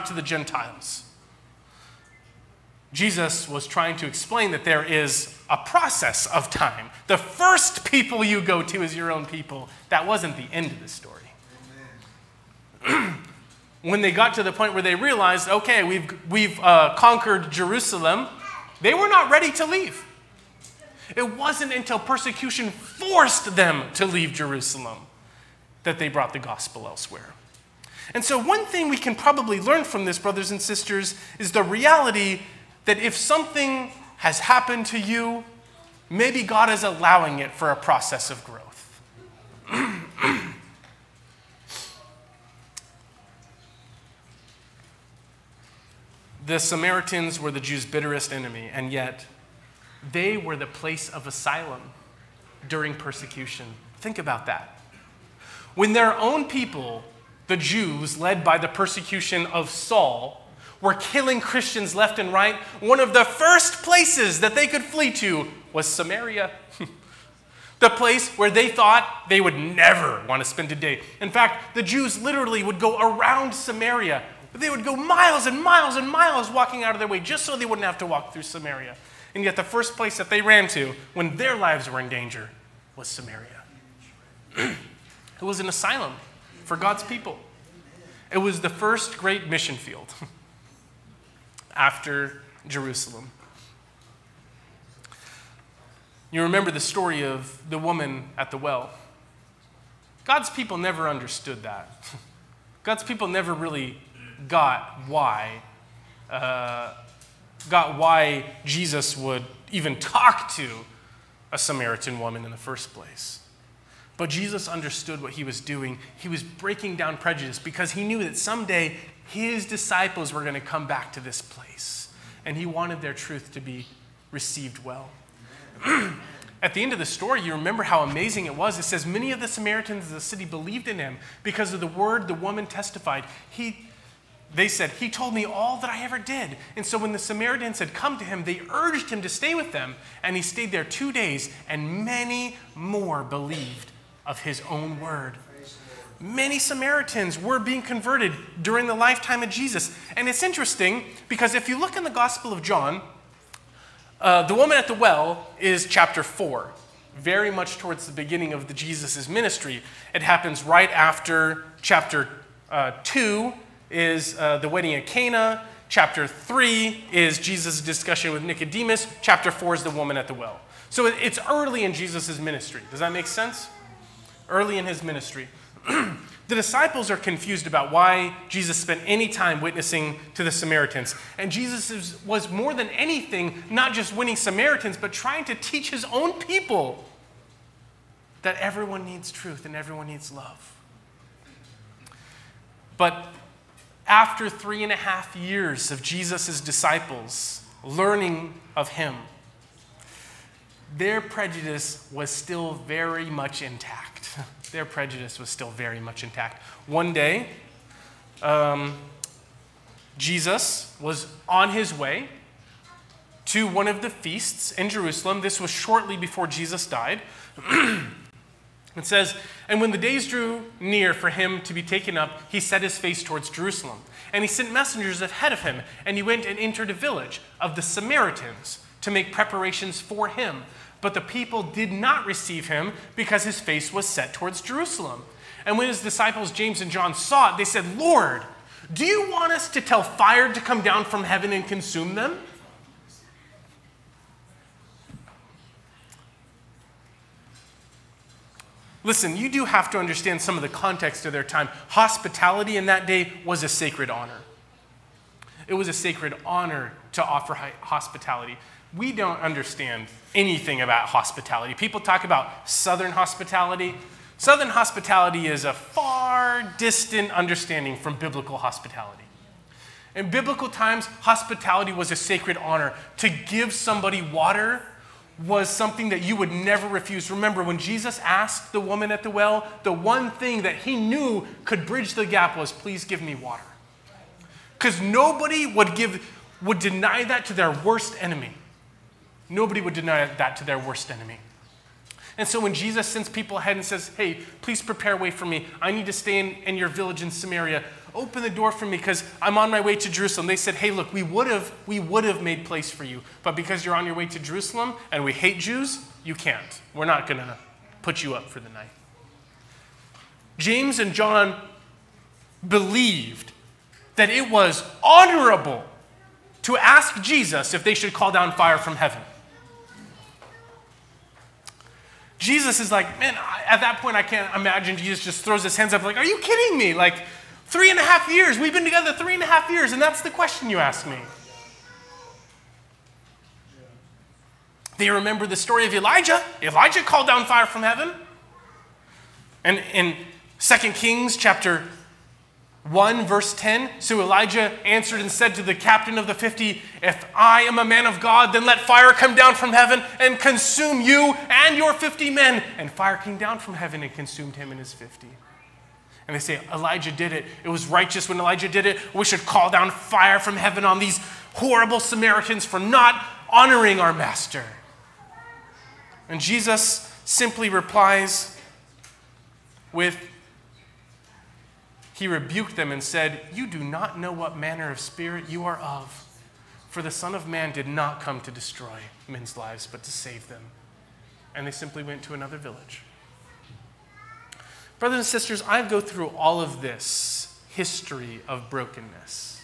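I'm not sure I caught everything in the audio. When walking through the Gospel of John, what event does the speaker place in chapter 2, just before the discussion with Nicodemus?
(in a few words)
The wedding at Cana.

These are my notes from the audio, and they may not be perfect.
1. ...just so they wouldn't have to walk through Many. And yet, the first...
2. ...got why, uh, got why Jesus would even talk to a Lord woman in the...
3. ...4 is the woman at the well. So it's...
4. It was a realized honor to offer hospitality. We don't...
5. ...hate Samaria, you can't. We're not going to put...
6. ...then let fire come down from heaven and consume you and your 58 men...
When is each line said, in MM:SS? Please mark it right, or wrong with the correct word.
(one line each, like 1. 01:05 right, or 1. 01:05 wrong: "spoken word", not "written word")
1. 01:17 wrong: "Samaria", not "Many"
2. 01:44 wrong: "Samaritan", not "Lord"
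3. 02:49 right
4. 04:15 wrong: "sacred", not "realized"
5. 05:05 wrong: "Jews", not "Samaria"
6. 05:48 wrong: "50", not "58".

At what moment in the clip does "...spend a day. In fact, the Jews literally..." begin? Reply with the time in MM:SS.
01:10.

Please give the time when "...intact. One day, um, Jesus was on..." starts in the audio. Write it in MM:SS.
03:26.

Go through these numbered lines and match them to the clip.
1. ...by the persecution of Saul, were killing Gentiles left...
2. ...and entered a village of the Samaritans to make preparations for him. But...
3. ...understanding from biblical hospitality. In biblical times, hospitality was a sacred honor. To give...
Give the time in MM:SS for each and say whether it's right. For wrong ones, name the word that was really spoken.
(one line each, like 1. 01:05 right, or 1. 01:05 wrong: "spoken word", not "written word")
1. 00:58 wrong: "Christians", not "Gentiles"
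2. 03:46 right
3. 04:27 right.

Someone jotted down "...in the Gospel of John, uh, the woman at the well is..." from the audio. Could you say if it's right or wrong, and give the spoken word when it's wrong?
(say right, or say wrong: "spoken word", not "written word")
right.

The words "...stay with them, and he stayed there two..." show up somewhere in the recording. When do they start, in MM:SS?
02:19.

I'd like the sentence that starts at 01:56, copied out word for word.
He was breaking down prejudice because he knew that someday his disciples were going to come back to this place.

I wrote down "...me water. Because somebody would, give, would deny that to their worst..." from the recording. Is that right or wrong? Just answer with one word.
wrong.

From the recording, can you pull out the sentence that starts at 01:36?
You remember the story of the woman at the well.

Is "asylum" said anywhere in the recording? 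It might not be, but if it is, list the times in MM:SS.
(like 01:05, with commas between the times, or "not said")
00:51, 01:25.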